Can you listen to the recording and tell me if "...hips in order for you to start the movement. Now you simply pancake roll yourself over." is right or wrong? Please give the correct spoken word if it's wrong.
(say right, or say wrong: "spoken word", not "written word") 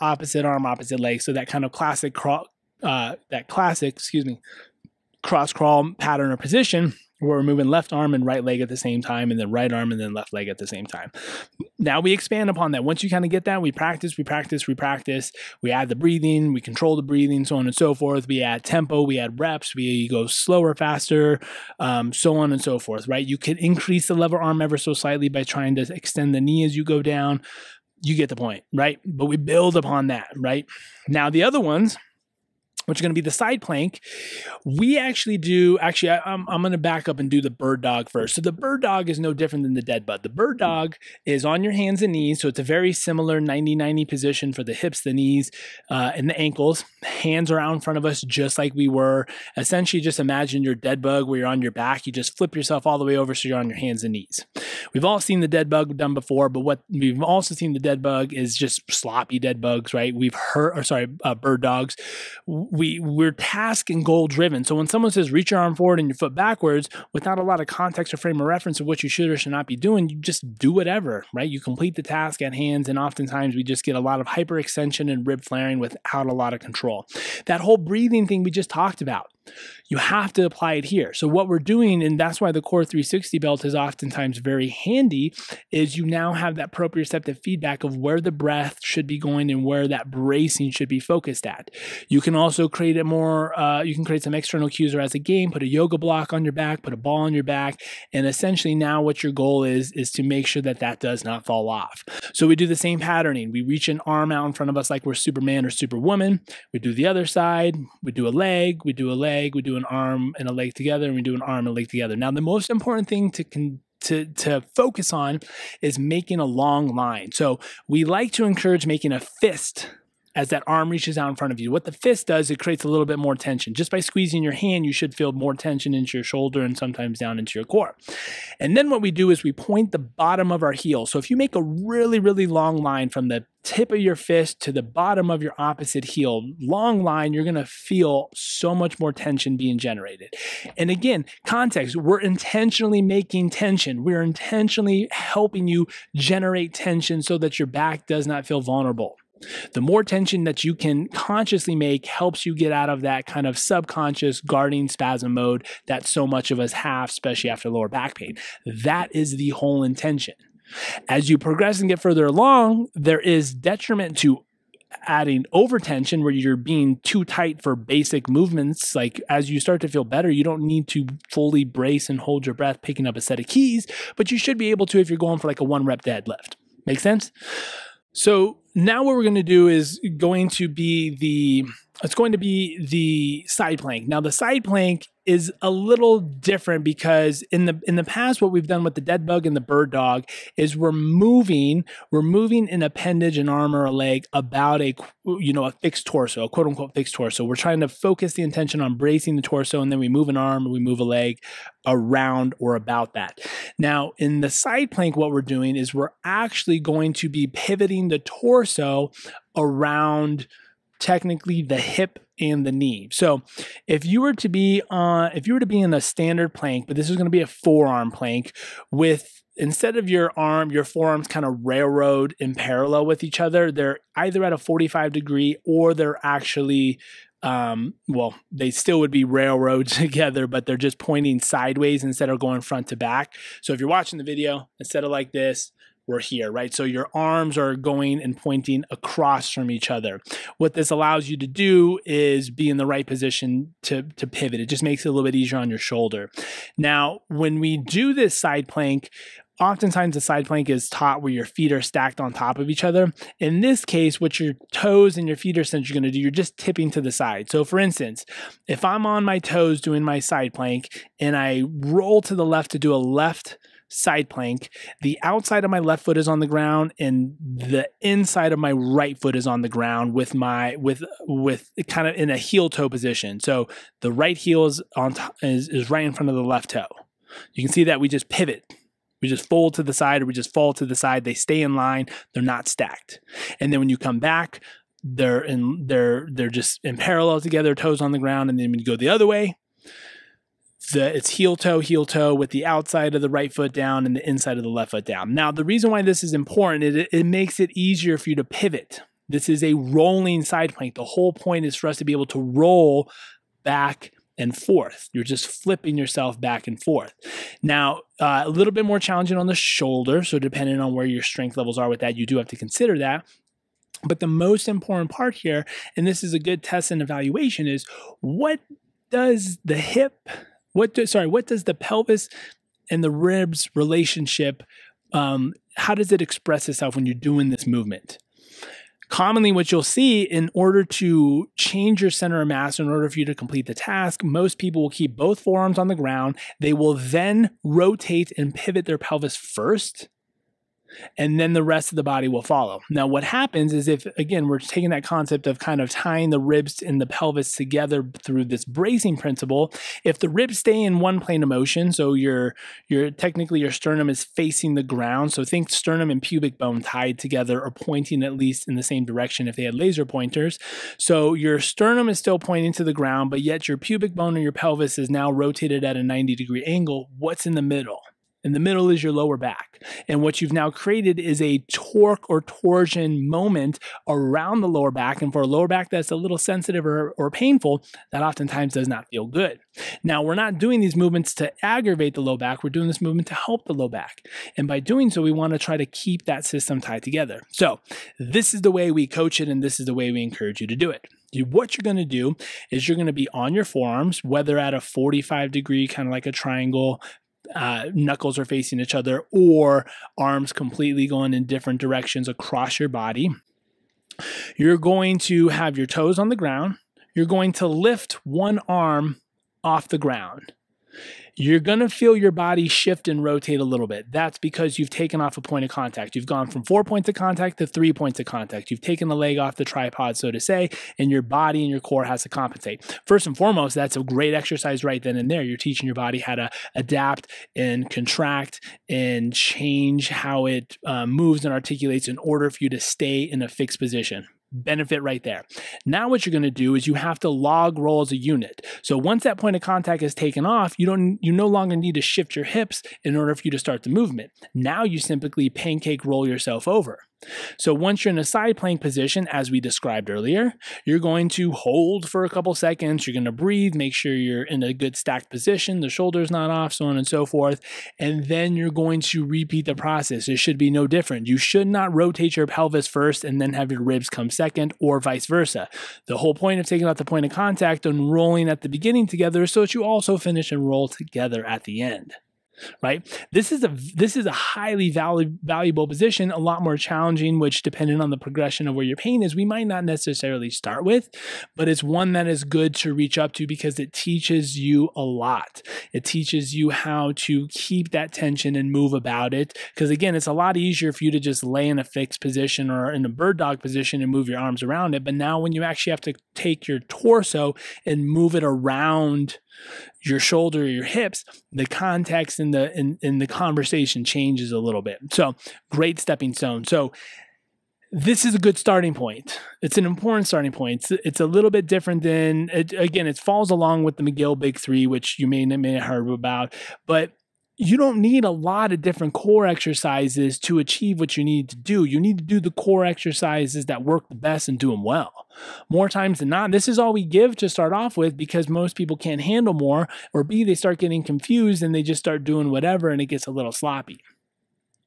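right.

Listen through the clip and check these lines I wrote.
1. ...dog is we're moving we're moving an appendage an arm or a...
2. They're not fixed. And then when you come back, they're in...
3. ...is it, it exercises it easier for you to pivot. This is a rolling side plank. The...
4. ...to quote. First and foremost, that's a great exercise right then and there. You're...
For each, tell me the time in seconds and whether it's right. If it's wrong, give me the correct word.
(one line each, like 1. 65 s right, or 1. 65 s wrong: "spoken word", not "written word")
1. 189 s right
2. 282 s wrong: "stacked", not "fixed"
3. 296 s wrong: "makes", not "exercises"
4. 422 s wrong: "compensate", not "quote".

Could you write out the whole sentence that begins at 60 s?
We've heard, or sorry, uh, bird dogs we we're task and goal driven.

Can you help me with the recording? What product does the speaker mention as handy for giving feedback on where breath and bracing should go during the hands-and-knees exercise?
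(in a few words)
Core 360 belt.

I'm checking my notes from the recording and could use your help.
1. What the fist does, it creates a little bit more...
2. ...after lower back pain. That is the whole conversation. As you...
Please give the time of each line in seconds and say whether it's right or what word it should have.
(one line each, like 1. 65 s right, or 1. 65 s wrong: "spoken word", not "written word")
1. 121 s right
2. 157 s wrong: "intention", not "conversation".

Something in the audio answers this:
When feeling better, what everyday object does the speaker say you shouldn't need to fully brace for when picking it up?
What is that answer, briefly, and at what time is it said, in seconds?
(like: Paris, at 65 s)
keys, at 173 s.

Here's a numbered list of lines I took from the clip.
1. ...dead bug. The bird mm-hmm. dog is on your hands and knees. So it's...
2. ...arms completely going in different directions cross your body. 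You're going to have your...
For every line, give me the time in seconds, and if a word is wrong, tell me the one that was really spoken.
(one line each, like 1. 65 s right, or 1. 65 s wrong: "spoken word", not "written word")
1. 39 s right
2. 400 s wrong: "across", not "cross".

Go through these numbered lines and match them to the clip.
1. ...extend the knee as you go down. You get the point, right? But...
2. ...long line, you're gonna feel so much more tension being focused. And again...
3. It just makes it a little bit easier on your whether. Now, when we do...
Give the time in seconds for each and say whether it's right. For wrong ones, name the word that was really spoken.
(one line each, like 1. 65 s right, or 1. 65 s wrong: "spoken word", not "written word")
1. 25 s right
2. 136 s wrong: "generated", not "focused"
3. 244 s wrong: "shoulder", not "whether".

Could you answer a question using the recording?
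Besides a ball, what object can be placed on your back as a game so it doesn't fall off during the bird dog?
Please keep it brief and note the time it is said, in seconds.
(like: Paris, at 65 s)
yoga block, at 95 s.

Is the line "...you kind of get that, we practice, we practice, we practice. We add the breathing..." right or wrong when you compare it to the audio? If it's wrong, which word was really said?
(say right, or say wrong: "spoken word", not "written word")
right.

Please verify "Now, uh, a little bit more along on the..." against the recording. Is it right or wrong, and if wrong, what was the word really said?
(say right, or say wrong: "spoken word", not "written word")
wrong: "challenging", not "along".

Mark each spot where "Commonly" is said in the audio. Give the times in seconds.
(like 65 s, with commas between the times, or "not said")
329 s.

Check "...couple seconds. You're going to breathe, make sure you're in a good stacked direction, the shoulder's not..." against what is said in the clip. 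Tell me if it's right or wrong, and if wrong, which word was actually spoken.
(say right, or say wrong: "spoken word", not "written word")
wrong: "position", not "direction".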